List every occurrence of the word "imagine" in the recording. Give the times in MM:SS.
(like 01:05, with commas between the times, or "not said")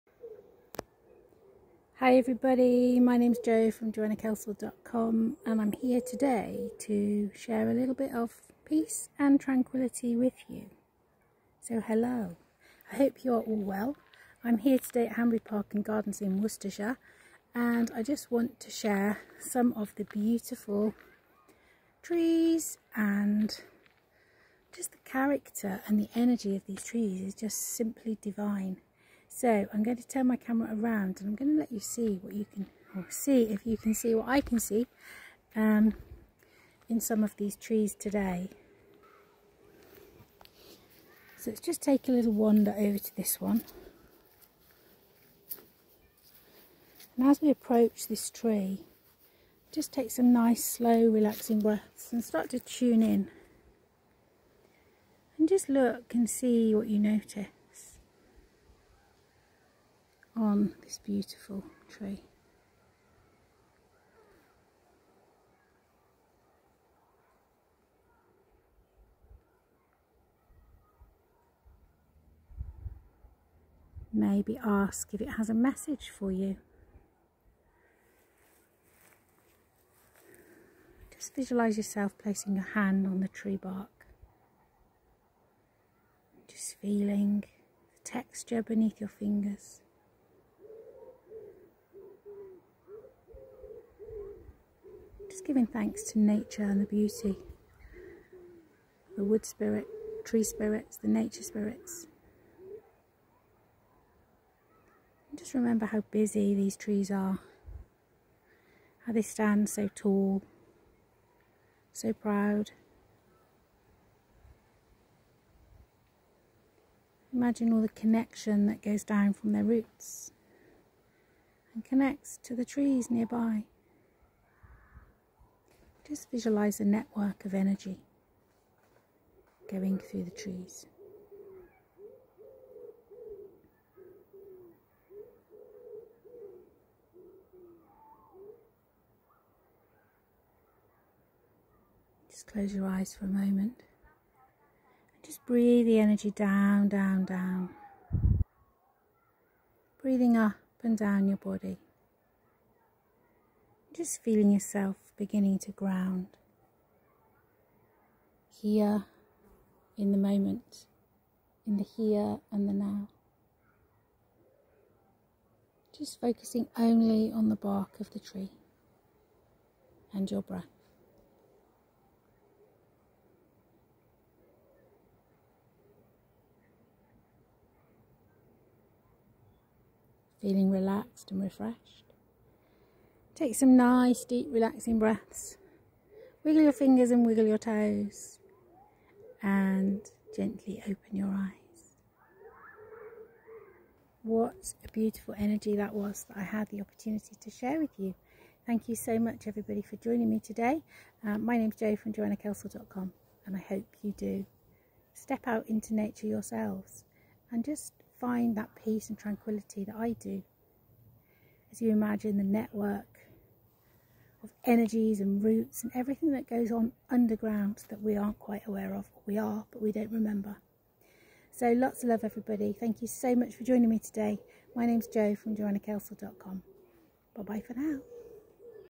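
01:57, 03:31.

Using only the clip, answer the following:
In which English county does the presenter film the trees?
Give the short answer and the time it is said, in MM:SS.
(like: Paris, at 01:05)
Worcestershire, at 00:16.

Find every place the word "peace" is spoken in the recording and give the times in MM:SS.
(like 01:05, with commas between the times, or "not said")
00:08, 03:28.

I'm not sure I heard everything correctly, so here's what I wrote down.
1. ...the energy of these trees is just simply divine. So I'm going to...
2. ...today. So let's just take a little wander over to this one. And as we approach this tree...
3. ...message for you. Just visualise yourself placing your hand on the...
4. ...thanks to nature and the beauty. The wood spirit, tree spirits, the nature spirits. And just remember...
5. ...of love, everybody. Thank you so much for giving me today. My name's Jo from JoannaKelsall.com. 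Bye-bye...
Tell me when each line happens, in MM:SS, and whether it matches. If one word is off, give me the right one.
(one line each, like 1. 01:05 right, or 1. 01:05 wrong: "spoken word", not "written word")
1. 00:25 right
2. 00:37 right
3. 01:15 right
4. 01:35 right
5. 03:42 wrong: "joining", not "giving".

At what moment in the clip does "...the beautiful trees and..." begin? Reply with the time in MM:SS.
00:19.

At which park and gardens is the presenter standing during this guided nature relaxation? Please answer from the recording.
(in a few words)
Hanbury Park and Gardens.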